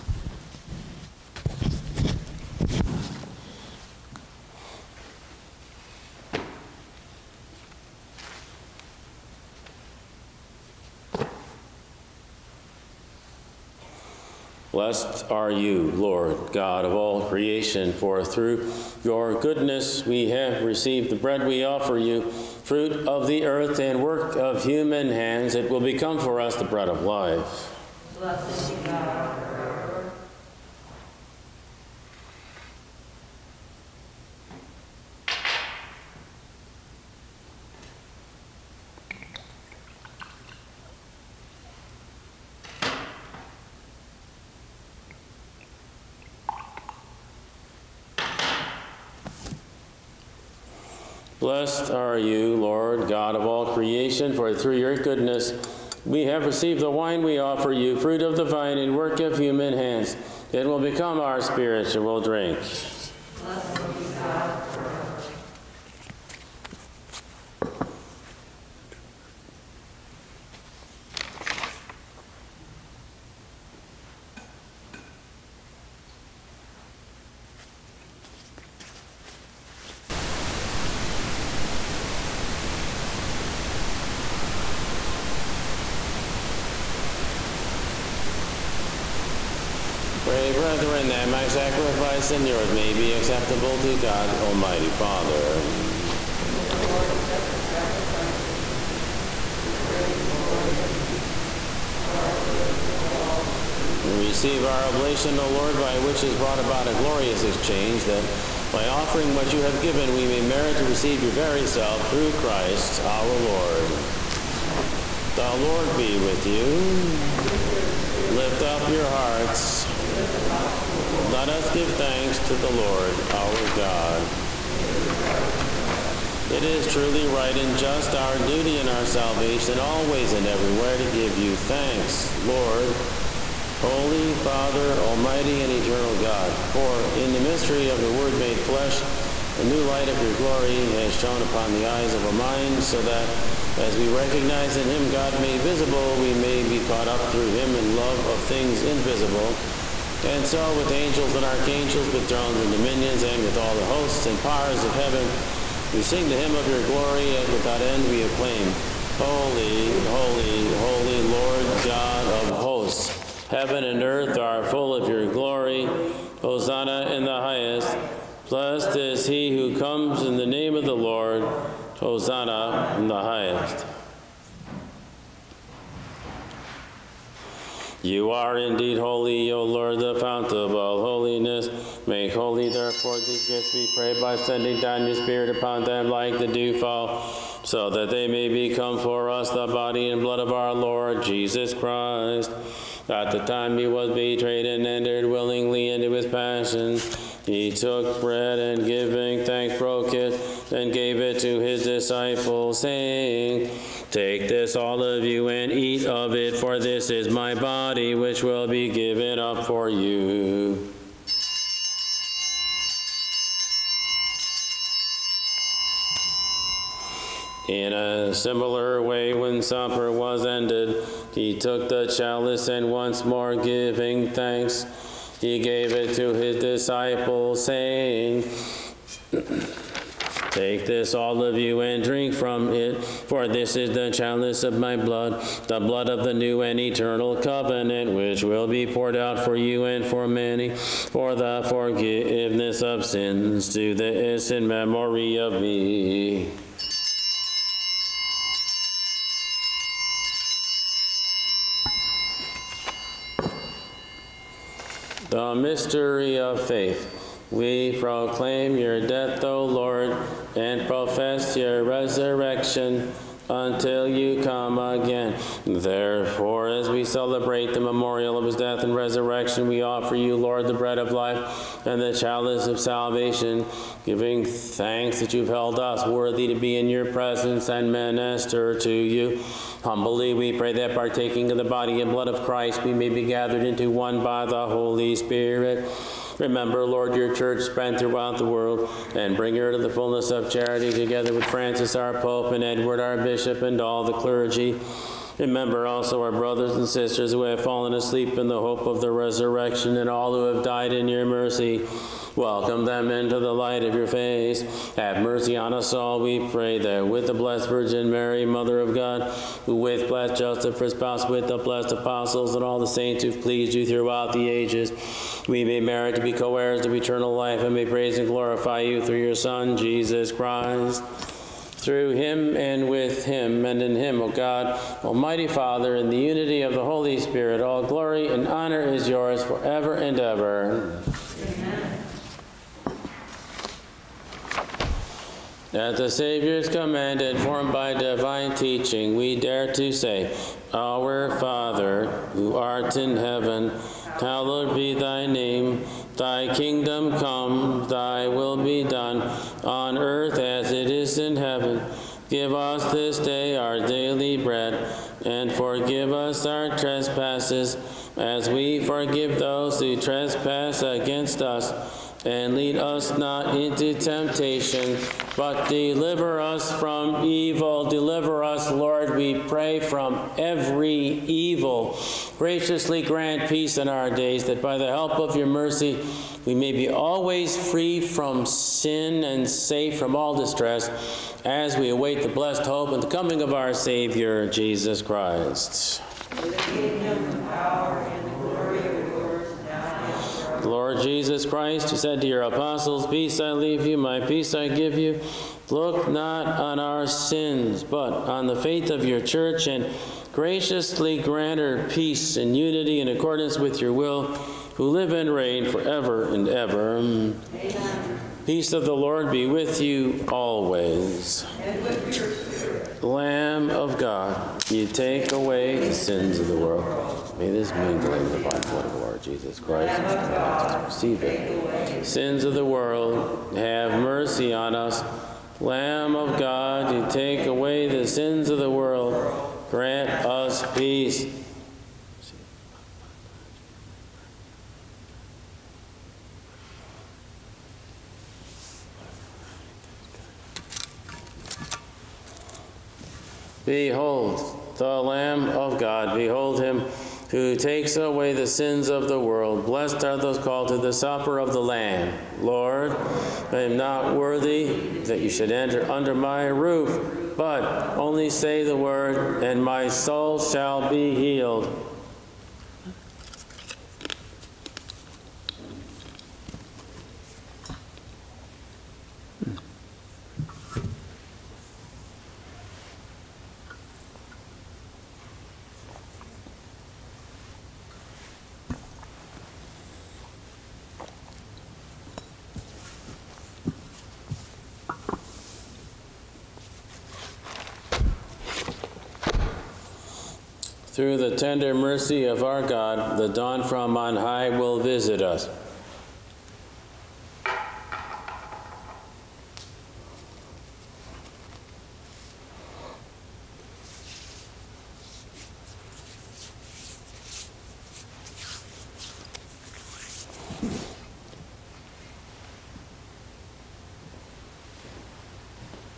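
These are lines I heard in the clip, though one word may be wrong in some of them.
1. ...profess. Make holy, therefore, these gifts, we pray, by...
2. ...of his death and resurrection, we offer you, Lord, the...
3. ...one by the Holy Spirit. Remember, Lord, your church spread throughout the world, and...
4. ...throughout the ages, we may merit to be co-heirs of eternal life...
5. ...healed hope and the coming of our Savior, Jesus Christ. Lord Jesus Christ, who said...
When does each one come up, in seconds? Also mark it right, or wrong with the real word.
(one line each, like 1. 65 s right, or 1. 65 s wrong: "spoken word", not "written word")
1. 181 s wrong: "holiness", not "profess"
2. 268 s right
3. 283 s right
4. 313 s right
5. 382 s wrong: "blessed", not "healed".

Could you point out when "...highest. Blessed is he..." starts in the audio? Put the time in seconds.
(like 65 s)
167 s.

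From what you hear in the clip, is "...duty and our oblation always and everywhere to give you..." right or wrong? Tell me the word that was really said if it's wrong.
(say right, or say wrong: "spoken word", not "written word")
wrong: "salvation", not "oblation".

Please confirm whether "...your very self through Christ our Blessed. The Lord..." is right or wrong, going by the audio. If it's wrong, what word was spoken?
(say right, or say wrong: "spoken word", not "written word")
wrong: "Lord", not "Blessed".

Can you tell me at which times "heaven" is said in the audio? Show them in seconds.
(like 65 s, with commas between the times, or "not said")
154 s, 163 s, 343 s, 351 s.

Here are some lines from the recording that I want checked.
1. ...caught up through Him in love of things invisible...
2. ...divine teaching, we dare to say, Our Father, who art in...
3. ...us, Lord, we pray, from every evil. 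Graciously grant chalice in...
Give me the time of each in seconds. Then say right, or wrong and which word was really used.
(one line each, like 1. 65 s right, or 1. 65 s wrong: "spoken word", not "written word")
1. 146 s right
2. 337 s right
3. 368 s wrong: "peace", not "chalice".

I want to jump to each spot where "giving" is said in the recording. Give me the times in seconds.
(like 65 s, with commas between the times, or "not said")
198 s, 223 s, 274 s.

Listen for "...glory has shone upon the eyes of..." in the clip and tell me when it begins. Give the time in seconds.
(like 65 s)
140 s.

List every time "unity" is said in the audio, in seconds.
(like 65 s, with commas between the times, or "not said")
326 s, 402 s.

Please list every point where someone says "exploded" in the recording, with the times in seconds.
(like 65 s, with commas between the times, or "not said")
not said.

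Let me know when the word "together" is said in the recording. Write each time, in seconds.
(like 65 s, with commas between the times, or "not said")
290 s.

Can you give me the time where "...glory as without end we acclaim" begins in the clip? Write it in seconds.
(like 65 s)
156 s.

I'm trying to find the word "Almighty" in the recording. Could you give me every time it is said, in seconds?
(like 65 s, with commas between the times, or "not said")
94 s, 134 s, 325 s.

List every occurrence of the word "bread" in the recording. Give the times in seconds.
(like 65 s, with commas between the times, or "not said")
21 s, 26 s, 198 s, 270 s, 354 s.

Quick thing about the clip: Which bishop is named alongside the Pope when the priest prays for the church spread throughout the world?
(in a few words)
Edward.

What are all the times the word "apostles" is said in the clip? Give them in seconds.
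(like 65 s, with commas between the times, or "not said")
311 s, 392 s.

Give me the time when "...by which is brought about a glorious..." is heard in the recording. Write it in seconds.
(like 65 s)
105 s.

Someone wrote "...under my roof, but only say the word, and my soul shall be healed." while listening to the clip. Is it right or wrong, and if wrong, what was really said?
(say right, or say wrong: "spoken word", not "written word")
right.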